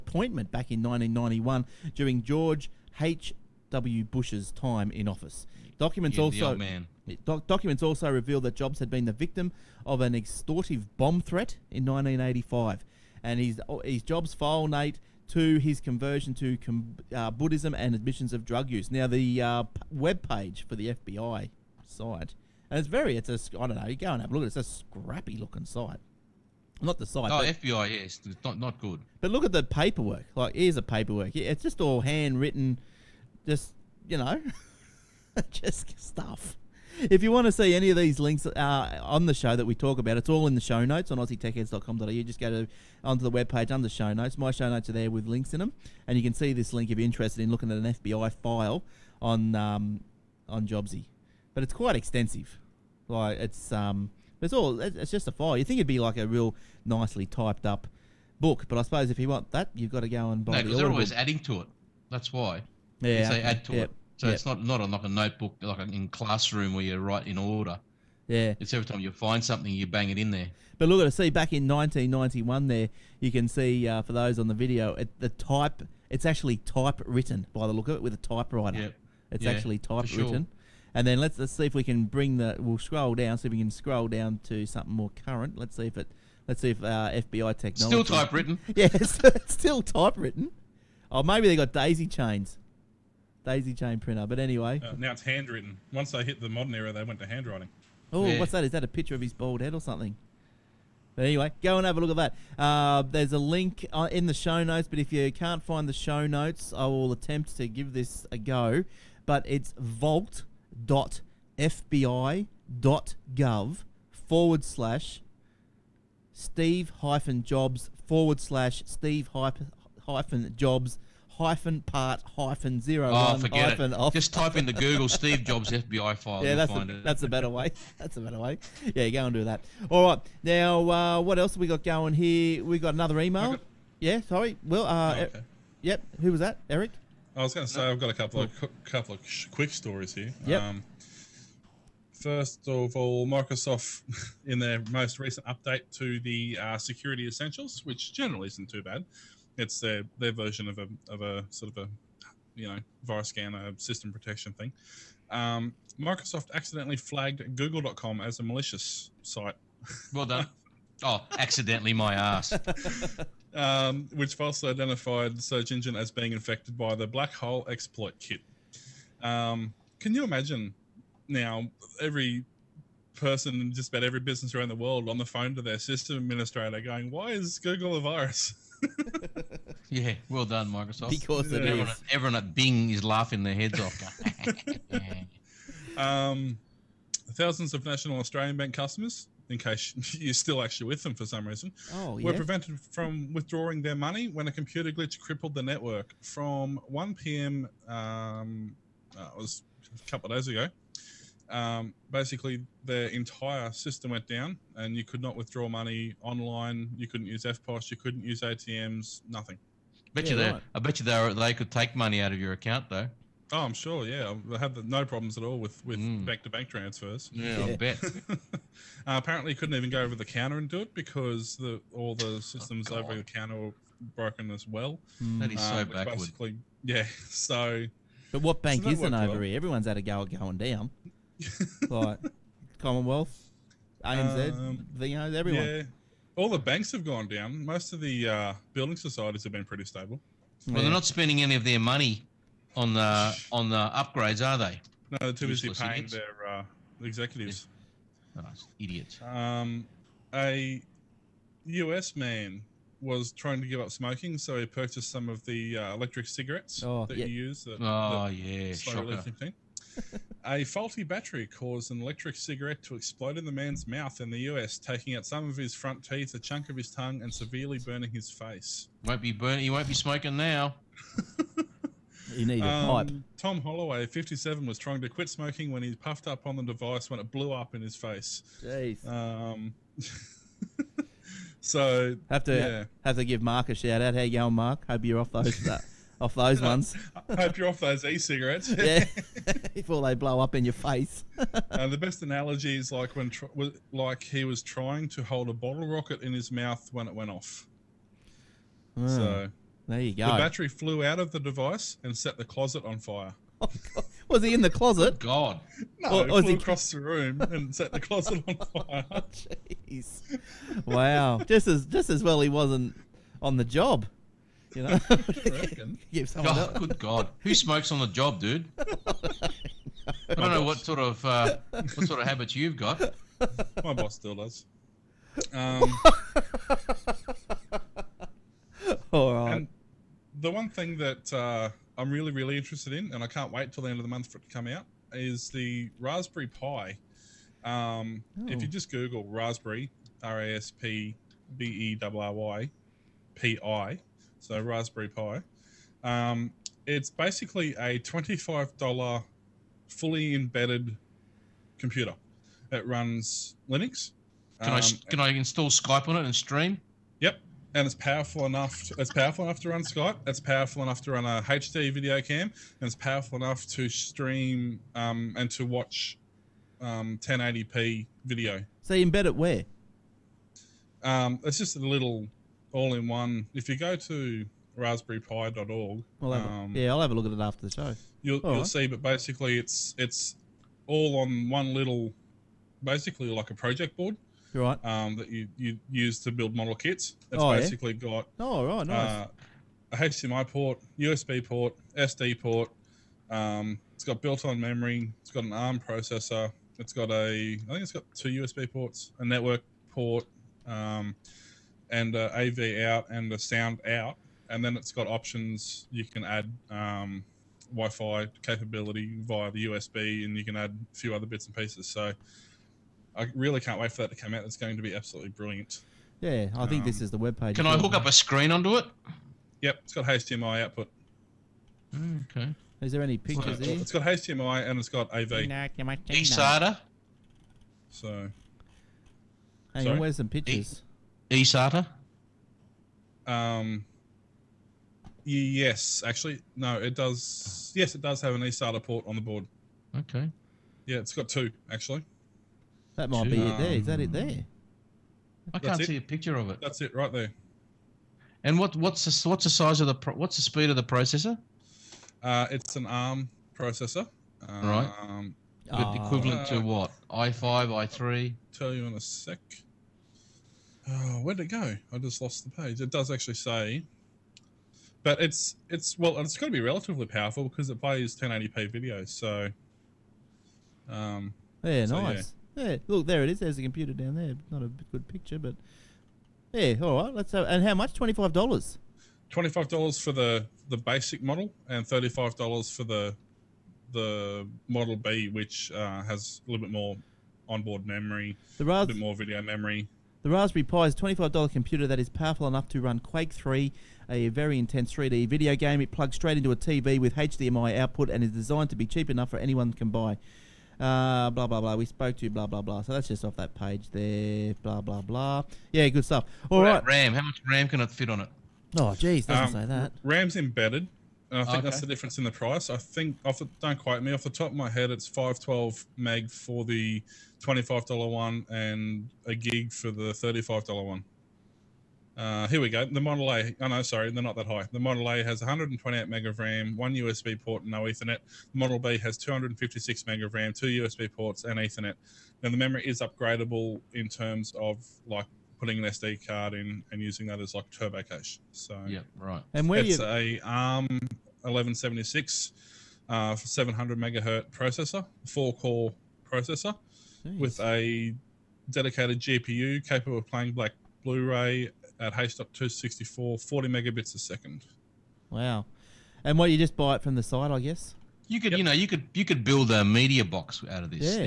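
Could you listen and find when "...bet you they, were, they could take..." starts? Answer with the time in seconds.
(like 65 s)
210 s.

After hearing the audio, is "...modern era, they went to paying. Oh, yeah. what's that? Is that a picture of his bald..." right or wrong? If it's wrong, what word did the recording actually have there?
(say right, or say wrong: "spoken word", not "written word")
wrong: "handwriting", not "paying".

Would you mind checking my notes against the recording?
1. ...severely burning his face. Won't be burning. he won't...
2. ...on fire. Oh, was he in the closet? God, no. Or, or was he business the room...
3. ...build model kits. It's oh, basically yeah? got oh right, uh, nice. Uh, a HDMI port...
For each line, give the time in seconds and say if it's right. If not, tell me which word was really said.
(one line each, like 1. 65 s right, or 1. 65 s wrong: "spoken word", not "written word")
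1. 267 s right
2. 302 s wrong: "across", not "business"
3. 386 s right.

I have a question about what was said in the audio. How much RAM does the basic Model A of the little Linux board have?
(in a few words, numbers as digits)
128 MB.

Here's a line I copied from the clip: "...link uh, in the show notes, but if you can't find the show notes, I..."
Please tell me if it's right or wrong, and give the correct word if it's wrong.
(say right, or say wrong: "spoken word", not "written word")
right.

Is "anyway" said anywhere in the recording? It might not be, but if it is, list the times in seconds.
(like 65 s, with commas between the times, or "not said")
94 s, 101 s.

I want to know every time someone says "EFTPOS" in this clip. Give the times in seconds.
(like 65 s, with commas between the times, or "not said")
207 s.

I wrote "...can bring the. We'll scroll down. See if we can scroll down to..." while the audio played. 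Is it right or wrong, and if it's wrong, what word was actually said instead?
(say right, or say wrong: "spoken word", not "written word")
right.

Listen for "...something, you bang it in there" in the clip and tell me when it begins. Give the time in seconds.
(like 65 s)
69 s.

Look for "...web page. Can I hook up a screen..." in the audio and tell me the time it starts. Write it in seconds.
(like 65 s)
417 s.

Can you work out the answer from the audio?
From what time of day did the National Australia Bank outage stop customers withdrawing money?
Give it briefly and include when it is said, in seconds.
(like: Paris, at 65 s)
1 p.m., at 196 s.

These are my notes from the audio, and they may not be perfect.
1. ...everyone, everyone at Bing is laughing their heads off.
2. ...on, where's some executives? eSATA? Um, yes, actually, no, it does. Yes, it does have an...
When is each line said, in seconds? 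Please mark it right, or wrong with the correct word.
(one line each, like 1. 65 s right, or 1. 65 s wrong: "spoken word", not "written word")
1. 181 s right
2. 429 s wrong: "pictures", not "executives".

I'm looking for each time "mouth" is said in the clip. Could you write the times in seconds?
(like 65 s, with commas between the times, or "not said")
263 s, 296 s.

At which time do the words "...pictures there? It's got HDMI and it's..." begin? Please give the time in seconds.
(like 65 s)
423 s.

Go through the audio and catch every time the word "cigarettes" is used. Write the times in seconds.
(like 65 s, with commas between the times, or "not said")
256 s, 262 s, 288 s.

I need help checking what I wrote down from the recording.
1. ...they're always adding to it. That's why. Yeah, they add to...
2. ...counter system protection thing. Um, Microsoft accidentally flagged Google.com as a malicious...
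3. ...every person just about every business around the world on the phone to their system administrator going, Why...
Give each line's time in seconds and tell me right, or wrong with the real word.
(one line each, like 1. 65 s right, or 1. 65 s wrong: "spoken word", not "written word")
1. 60 s right
2. 153 s wrong: "scanner", not "counter"
3. 171 s right.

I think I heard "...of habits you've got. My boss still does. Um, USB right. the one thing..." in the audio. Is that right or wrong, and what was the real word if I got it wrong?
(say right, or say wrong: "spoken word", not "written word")
wrong: "All", not "USB".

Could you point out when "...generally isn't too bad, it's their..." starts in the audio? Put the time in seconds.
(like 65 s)
148 s.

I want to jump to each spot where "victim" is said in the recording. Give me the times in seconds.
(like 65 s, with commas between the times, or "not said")
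9 s.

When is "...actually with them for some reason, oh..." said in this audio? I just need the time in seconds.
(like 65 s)
190 s.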